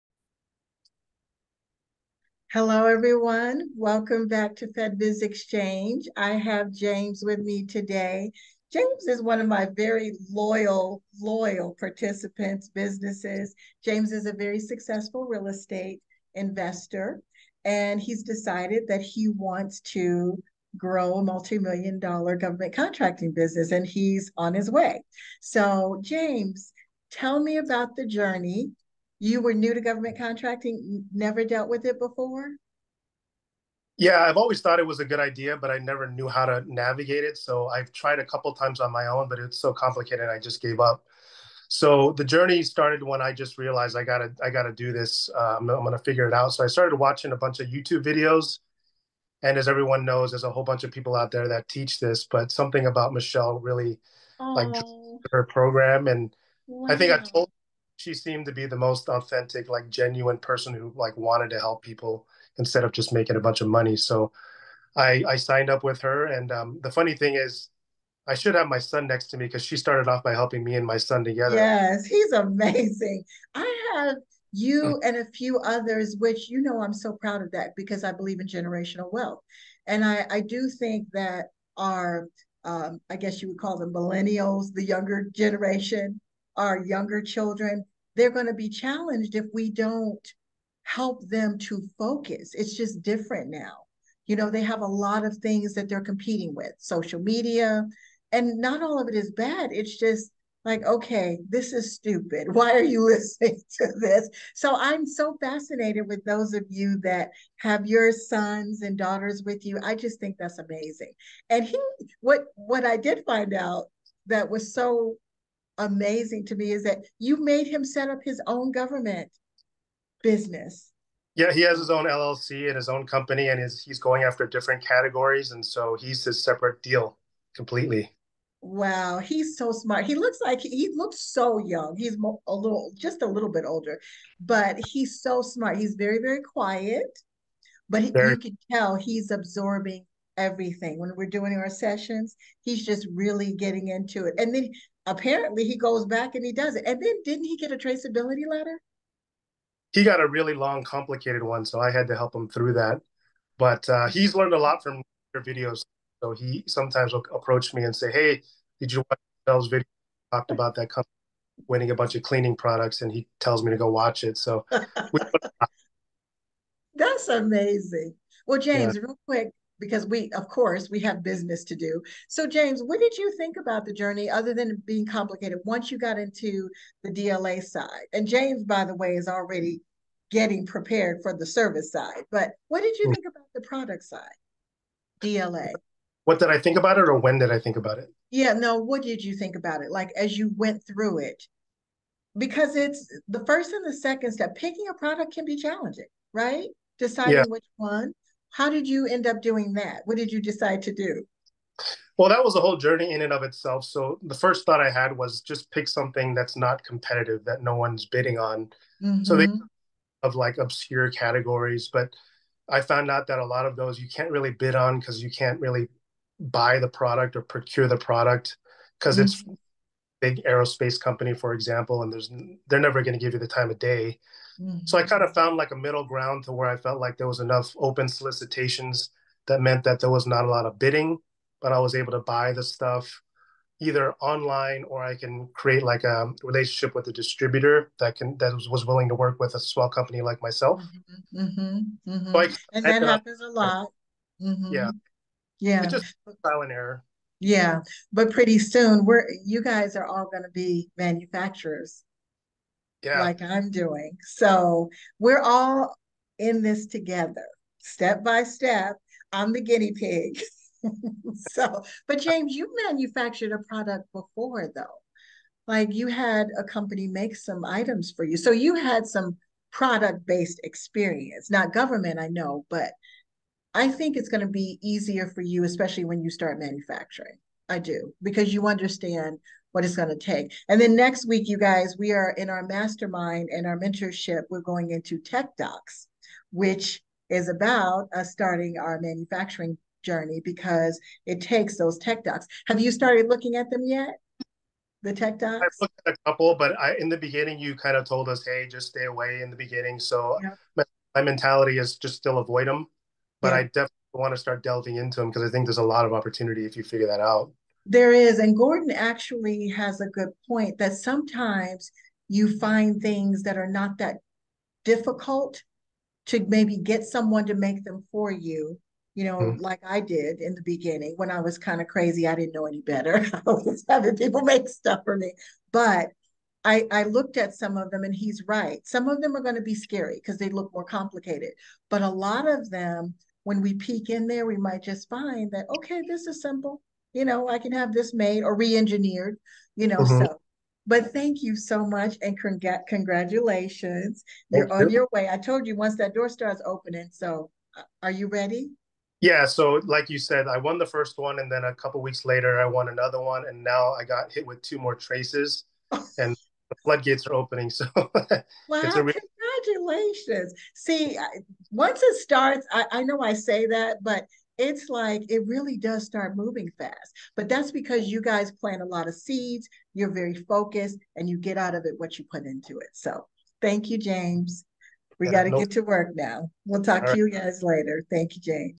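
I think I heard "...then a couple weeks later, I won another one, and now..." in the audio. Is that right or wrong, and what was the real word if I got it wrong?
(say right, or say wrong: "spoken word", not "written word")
right.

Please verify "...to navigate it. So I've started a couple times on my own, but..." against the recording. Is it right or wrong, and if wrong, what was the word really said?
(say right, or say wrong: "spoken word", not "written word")
wrong: "tried", not "started".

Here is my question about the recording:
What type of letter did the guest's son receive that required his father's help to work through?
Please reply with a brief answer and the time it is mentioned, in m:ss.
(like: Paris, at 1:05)
Traceability letter, at 2:27.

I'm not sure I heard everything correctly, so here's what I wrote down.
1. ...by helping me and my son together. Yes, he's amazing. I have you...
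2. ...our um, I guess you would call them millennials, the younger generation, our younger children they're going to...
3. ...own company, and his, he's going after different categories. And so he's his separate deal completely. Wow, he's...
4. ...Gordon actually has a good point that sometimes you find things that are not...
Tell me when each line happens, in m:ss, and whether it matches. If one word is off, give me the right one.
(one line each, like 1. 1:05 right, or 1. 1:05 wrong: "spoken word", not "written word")
1. 1:10 right
2. 1:21 right
3. 2:02 right
4. 5:08 right.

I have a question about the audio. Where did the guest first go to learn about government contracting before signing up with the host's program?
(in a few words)
YouTube videos.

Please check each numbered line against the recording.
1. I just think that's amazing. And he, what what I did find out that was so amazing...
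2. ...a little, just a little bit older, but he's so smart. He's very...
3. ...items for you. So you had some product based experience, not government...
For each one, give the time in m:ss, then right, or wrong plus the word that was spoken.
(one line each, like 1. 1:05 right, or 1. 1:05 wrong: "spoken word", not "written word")
1. 1:49 right
2. 2:12 right
3. 4:27 right.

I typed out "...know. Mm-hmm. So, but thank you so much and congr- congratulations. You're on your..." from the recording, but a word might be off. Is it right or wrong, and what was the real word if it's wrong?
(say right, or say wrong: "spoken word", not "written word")
right.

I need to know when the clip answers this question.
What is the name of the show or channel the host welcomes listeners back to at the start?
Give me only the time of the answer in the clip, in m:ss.
0:04.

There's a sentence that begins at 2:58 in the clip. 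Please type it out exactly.
And James, by the way, is already getting prepared for the service side.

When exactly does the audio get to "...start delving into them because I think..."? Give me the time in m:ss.
5:04.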